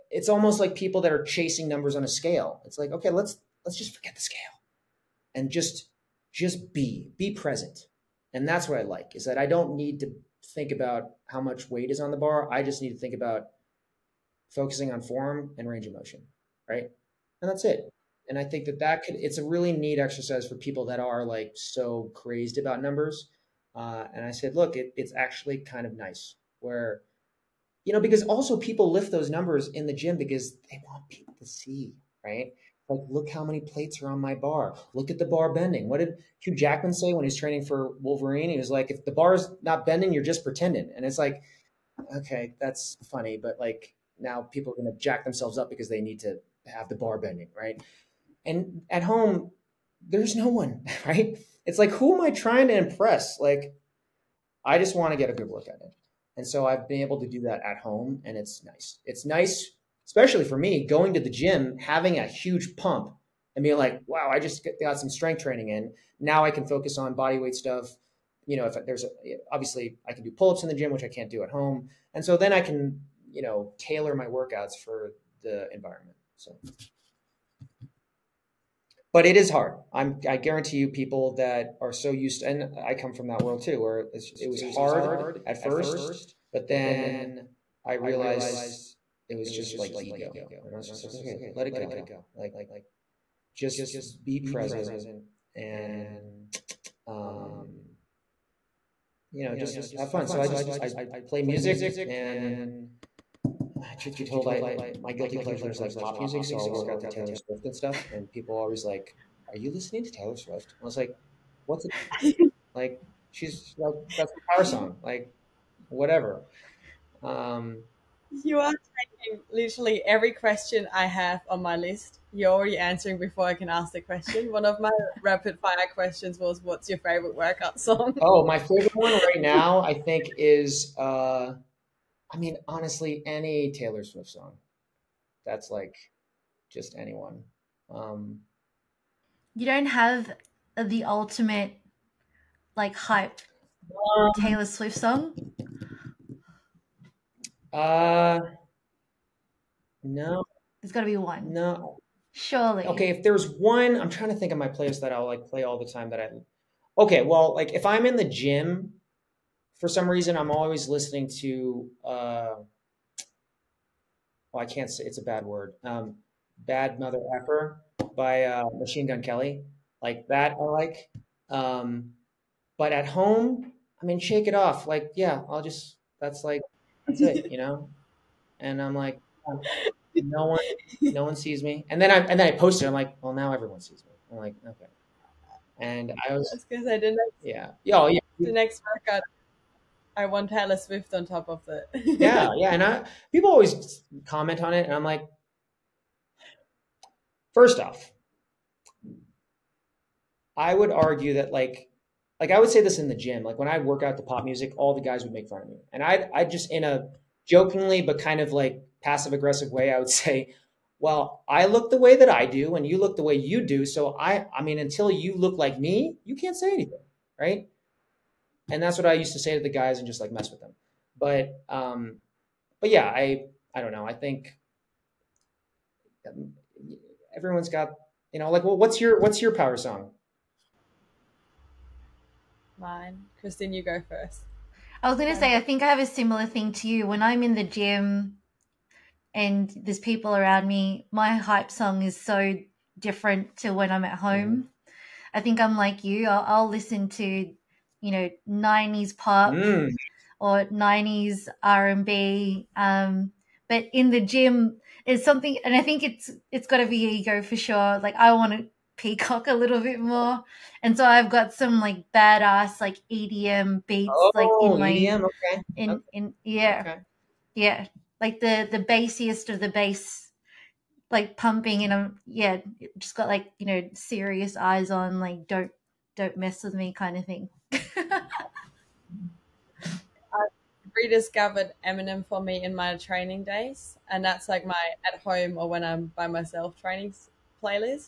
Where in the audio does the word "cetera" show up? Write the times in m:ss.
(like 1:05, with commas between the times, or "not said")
not said.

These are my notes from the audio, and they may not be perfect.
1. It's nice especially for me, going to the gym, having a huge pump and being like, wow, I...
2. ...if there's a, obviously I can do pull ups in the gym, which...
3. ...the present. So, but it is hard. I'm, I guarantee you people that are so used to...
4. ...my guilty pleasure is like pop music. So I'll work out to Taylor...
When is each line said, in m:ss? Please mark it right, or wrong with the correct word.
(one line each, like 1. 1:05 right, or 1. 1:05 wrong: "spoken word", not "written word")
1. 0:59 right
2. 1:08 right
3. 1:15 wrong: "environment", not "present"
4. 1:44 right.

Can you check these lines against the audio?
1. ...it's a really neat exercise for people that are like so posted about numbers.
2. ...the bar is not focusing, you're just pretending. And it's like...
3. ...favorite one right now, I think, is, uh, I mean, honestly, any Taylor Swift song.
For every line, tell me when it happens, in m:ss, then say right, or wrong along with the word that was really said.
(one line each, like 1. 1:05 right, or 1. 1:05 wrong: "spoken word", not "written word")
1. 0:19 wrong: "crazed", not "posted"
2. 0:39 wrong: "bending", not "focusing"
3. 2:08 right.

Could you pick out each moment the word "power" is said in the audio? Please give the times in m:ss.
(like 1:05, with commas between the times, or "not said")
1:54, 3:49.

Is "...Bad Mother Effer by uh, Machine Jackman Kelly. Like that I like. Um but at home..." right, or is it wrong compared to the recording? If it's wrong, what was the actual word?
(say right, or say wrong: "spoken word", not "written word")
wrong: "Gun", not "Jackman".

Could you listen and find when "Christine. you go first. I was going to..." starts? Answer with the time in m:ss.
3:53.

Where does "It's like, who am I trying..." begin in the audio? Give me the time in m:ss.
0:51.